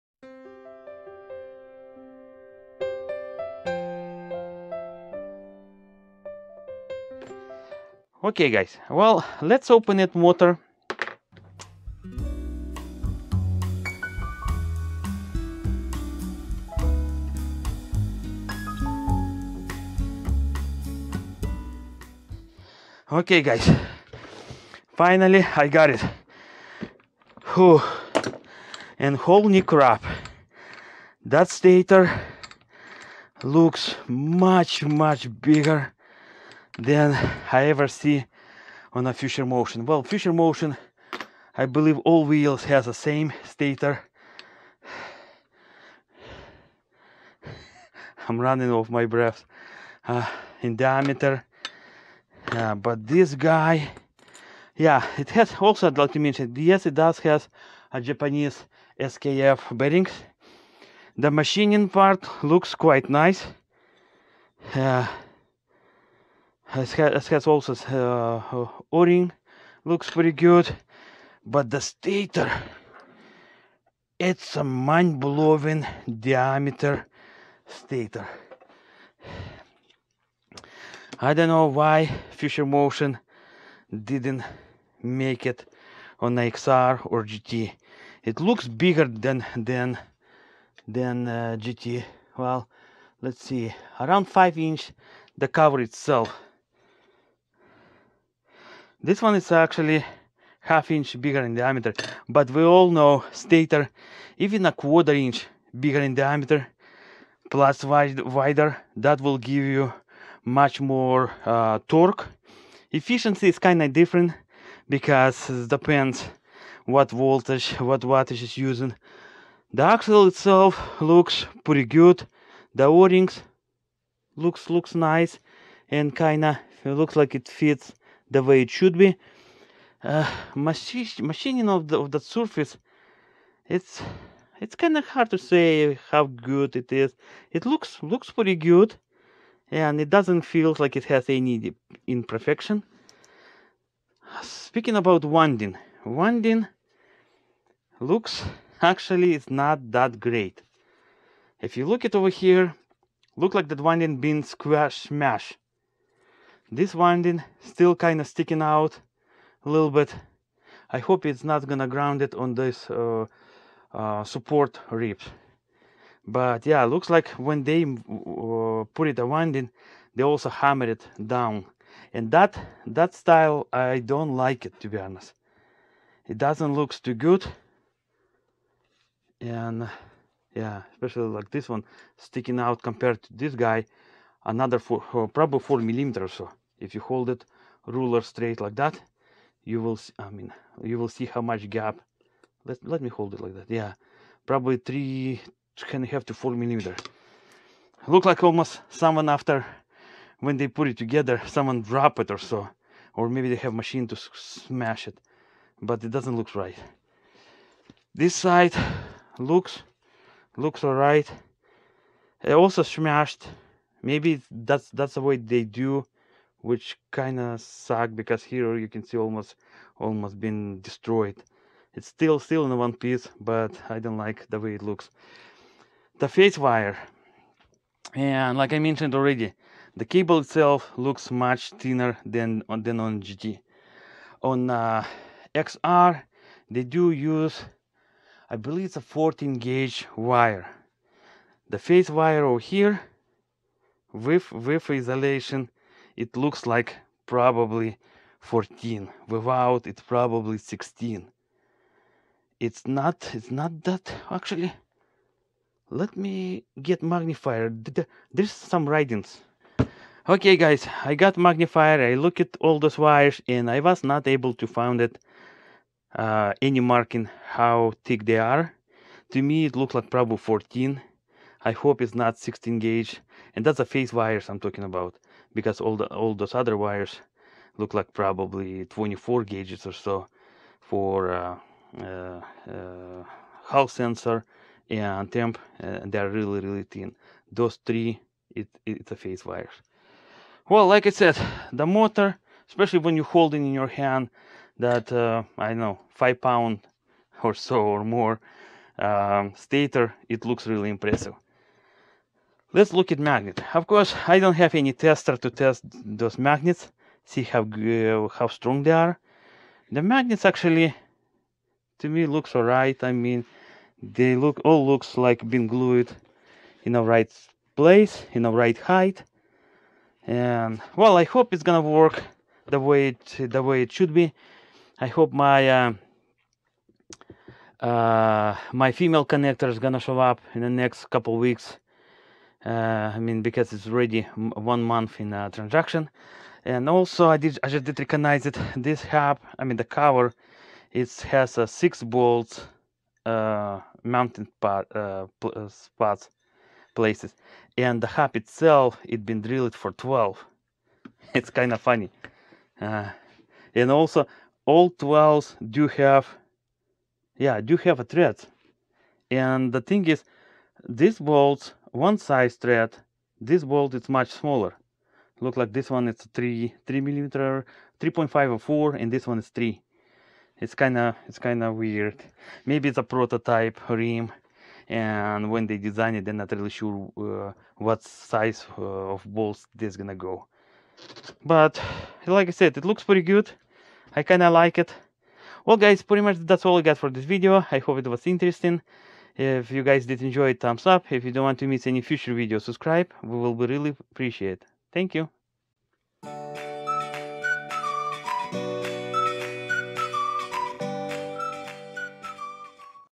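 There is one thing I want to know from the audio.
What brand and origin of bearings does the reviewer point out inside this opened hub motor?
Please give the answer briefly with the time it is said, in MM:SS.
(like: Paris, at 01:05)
Japanese SKF, at 00:58.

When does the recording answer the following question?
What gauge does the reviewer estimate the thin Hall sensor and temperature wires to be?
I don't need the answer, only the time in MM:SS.
04:38.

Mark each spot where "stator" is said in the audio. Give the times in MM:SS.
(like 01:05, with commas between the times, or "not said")
00:31, 00:43, 01:11, 01:17, 01:43, 04:59.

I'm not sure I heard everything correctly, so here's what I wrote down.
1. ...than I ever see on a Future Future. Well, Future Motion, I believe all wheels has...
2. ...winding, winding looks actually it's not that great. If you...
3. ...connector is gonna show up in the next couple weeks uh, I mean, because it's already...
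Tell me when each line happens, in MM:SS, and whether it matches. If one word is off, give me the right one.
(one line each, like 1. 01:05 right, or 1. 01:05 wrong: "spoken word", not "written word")
1. 00:36 wrong: "Motion", not "Future"
2. 02:25 right
3. 05:29 right.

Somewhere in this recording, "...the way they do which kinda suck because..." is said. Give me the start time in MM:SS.
03:35.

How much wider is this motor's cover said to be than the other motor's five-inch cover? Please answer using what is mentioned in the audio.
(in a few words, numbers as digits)
half inch.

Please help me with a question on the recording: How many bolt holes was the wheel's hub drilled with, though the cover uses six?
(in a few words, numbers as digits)
12.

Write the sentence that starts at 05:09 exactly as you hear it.
The magnets actually, to me, looks alright.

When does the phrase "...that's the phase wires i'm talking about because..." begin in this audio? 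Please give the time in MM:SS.
04:33.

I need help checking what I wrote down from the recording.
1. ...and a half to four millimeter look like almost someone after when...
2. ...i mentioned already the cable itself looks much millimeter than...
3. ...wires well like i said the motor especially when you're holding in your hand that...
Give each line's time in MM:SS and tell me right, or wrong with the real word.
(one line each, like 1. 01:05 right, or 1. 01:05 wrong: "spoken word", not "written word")
1. 03:15 right
2. 03:48 wrong: "thinner", not "millimeter"
3. 04:49 right.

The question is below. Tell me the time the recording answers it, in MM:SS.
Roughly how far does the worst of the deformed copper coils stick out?
03:05.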